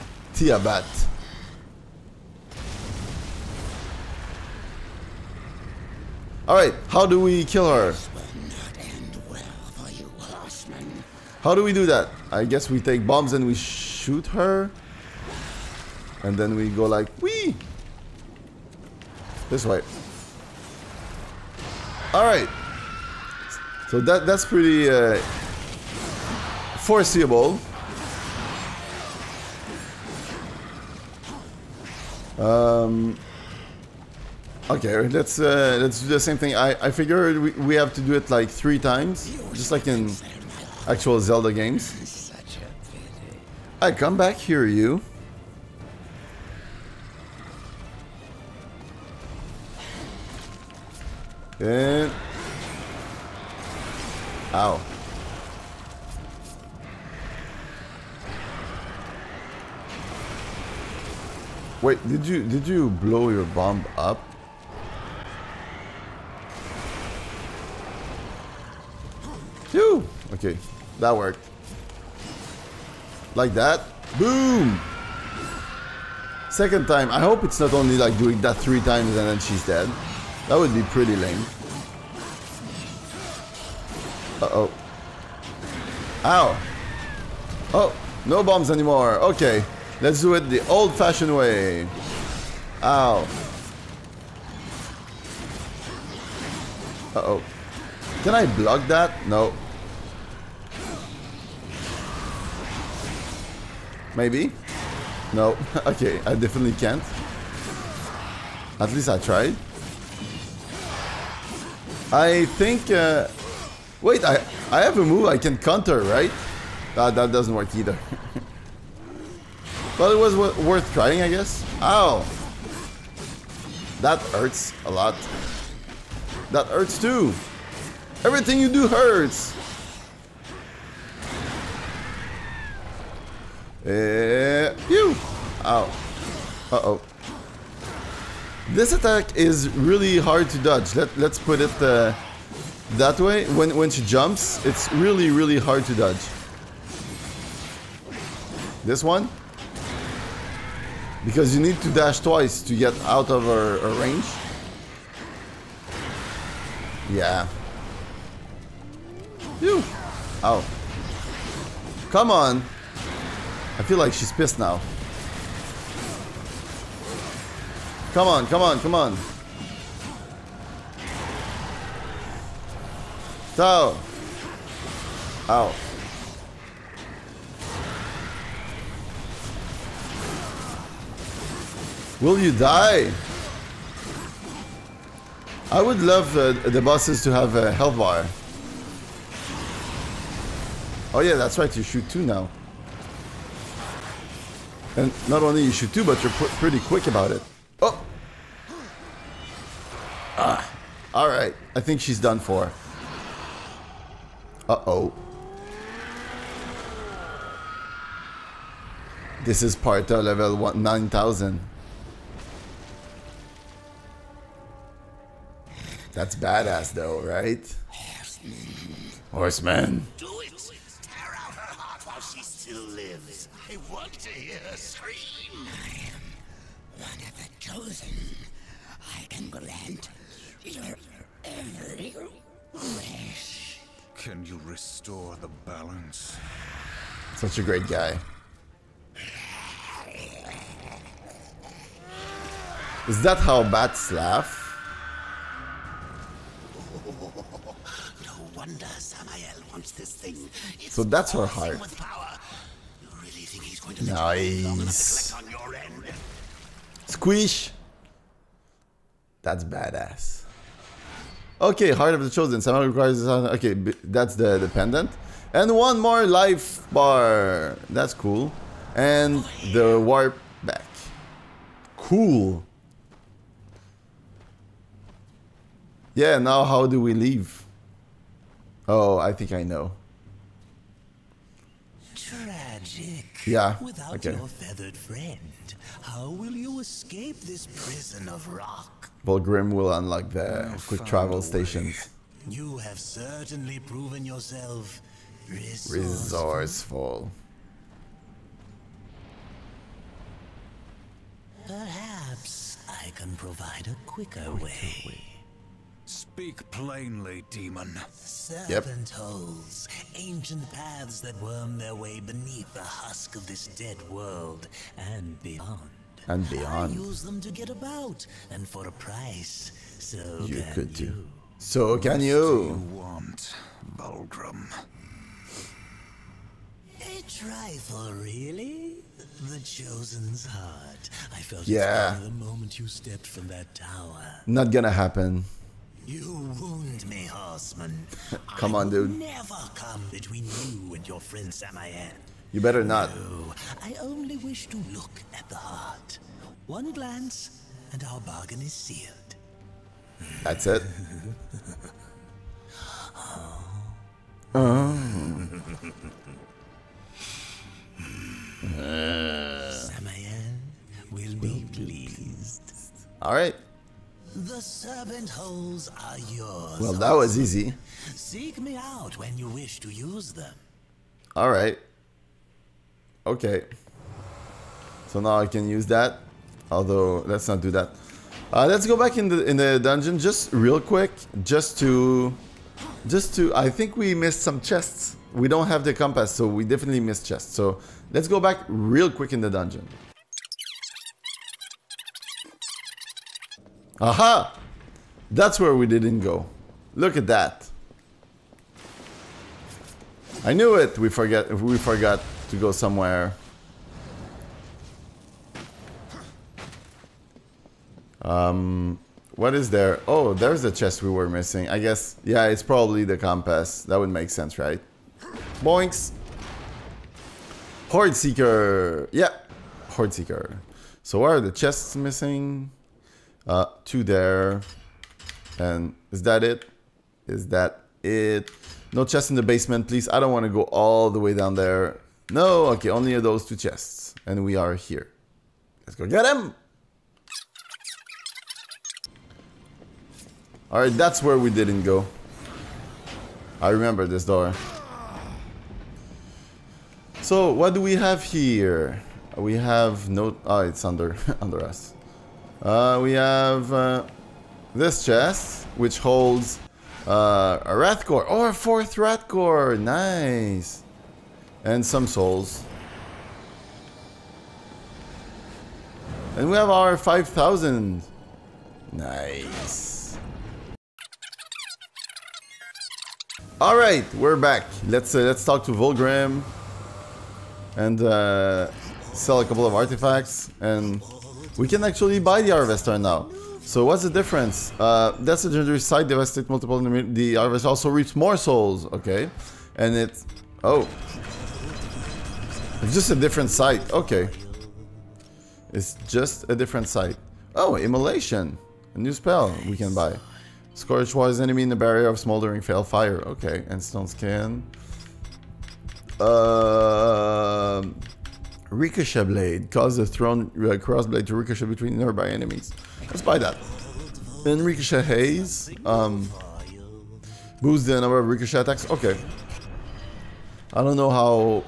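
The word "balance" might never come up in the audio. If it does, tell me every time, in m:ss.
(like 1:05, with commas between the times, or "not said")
3:55.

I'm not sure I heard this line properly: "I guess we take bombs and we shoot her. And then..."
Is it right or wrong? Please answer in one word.
right.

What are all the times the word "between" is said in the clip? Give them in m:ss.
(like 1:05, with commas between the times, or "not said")
5:40, 8:31.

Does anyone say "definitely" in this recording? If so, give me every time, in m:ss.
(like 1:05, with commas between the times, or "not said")
1:46, 6:26.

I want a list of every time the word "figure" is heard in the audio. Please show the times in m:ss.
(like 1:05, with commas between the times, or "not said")
0:36.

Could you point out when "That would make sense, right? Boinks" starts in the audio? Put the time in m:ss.
6:53.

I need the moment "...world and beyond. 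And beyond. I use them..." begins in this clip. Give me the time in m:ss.
5:14.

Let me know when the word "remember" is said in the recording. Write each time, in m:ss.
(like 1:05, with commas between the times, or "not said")
7:23.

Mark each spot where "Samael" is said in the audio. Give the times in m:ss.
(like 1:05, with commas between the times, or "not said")
4:08, 4:22, 5:41, 5:59.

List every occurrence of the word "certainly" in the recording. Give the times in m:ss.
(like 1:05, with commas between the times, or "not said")
4:52.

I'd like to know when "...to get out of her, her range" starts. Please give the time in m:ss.
2:32.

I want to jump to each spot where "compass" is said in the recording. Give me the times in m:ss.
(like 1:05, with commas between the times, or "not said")
6:25, 6:53.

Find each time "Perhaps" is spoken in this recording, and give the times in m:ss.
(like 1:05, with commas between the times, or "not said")
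5:01.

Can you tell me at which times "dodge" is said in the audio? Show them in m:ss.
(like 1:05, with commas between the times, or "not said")
2:20, 2:25.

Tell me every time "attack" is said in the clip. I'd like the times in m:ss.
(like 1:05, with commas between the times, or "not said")
2:18, 8:38.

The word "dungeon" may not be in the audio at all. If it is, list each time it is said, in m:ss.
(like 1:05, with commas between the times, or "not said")
6:19, 6:29.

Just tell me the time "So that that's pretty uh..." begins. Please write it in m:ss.
0:23.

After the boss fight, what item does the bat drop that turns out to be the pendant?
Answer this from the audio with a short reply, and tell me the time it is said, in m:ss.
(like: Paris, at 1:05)
Heart of the Chosen, at 4:21.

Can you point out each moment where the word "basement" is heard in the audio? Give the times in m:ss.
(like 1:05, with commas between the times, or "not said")
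7:09.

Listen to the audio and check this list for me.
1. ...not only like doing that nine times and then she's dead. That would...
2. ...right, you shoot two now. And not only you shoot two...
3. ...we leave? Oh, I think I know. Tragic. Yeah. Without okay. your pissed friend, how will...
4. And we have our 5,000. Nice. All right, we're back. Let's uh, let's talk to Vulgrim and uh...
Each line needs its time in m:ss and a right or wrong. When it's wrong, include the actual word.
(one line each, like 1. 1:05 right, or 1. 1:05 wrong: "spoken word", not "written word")
1. 1:17 wrong: "three", not "nine"
2. 3:11 right
3. 4:37 wrong: "feathered", not "pissed"
4. 7:46 right.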